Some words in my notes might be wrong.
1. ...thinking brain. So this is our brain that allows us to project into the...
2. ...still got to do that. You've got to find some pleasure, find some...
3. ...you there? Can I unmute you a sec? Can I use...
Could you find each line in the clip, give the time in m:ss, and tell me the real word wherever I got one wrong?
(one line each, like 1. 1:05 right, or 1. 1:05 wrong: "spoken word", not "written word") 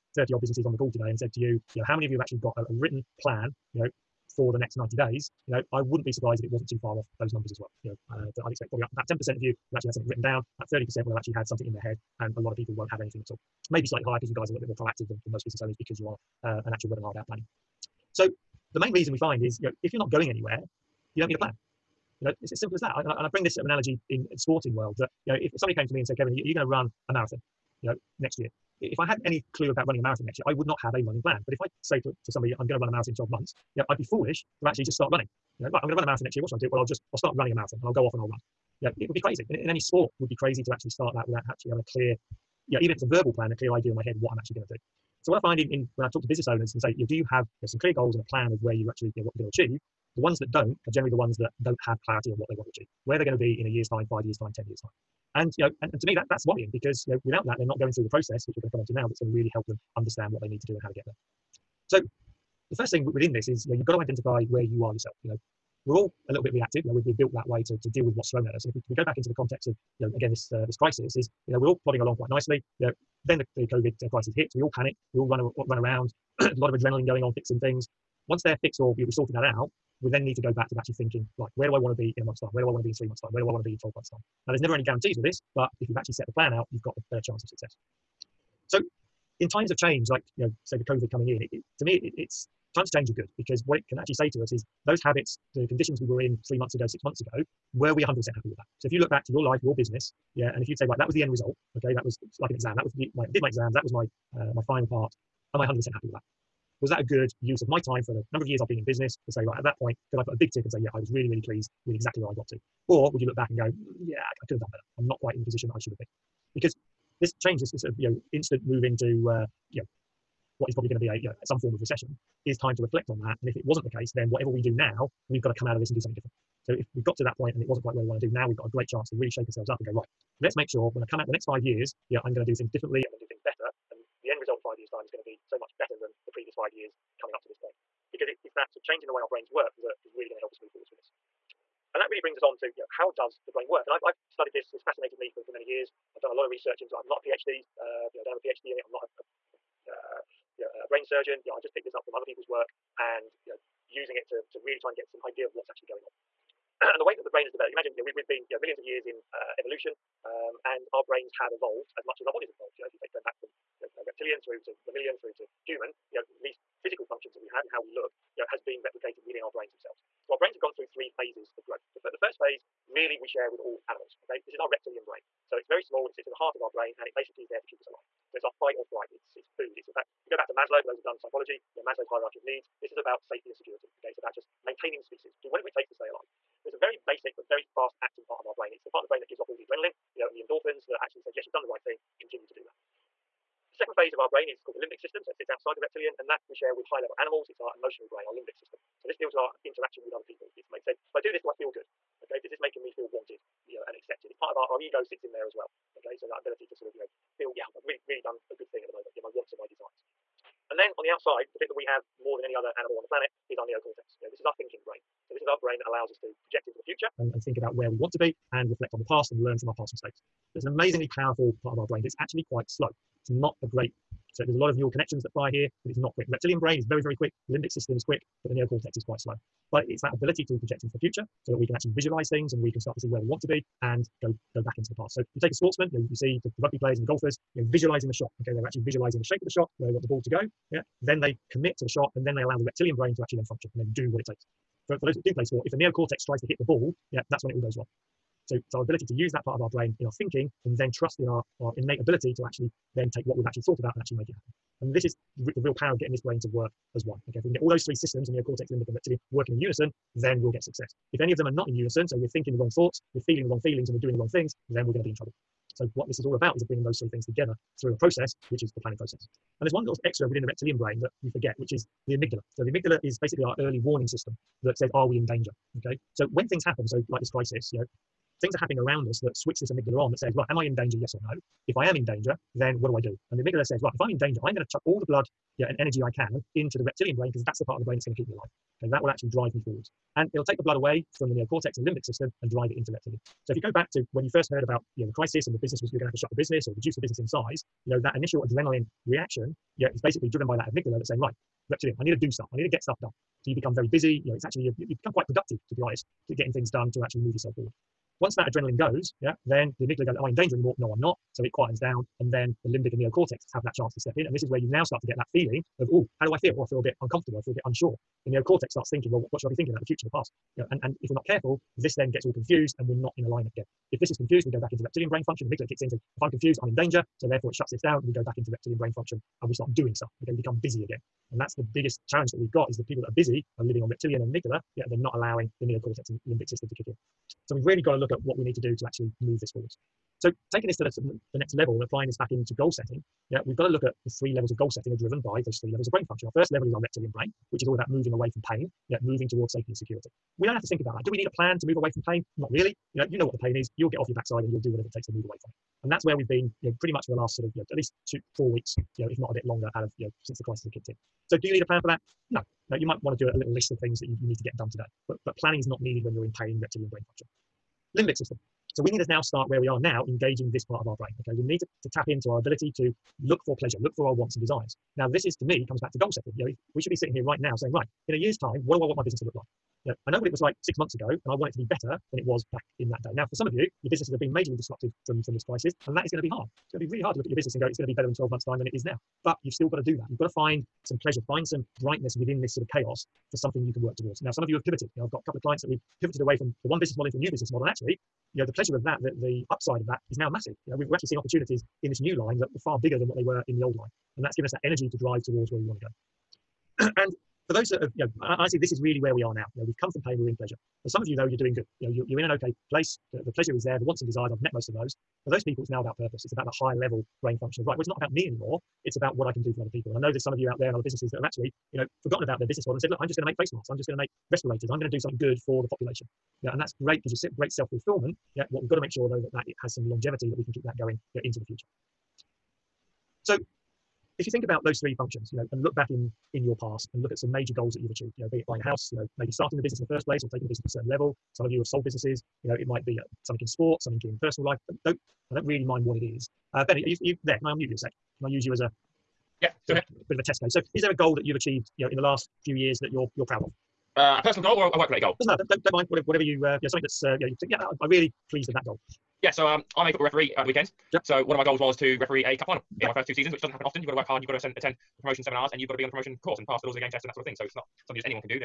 1. 3:34 right
2. 6:29 right
3. 7:27 right.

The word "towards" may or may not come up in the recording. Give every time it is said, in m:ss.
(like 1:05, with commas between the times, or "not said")
5:49, 6:33, 6:45.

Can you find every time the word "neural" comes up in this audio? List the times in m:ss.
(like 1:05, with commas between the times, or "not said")
3:44.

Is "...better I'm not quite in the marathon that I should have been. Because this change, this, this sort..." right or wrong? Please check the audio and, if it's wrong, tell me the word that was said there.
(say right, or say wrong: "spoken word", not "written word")
wrong: "position", not "marathon".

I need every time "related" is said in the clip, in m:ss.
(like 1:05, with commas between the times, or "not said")
7:34.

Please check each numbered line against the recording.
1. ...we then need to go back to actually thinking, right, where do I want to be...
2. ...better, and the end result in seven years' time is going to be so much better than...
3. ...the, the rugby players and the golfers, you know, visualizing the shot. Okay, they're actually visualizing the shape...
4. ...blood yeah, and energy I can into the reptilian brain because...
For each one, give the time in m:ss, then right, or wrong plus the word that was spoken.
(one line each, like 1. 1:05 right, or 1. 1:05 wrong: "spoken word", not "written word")
1. 1:20 right
2. 2:13 wrong: "five", not "seven"
3. 3:56 right
4. 4:45 right.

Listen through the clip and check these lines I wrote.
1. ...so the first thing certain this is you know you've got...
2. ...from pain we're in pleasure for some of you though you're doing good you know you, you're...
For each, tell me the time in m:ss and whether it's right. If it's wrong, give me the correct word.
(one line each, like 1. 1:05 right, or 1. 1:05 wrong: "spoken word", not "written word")
1. 1:01 wrong: "within", not "certain"
2. 6:49 right.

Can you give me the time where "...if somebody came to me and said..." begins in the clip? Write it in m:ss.
0:25.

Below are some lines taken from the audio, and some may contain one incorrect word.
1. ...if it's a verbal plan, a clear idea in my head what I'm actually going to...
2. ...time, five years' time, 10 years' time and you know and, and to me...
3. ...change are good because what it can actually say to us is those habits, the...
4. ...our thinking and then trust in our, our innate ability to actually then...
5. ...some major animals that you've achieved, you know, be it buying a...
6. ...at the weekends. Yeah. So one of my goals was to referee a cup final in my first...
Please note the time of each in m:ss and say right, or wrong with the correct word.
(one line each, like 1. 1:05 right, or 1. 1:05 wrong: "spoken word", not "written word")
1. 0:42 right
2. 0:53 right
3. 1:32 right
4. 4:10 right
5. 7:17 wrong: "goals", not "animals"
6. 7:40 right.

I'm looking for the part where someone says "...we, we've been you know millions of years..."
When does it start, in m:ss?
2:38.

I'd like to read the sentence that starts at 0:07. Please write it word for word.
You know, uh, I'd expect probably about 10% of you will actually have something written down.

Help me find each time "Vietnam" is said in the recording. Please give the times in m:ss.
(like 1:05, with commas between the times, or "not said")
not said.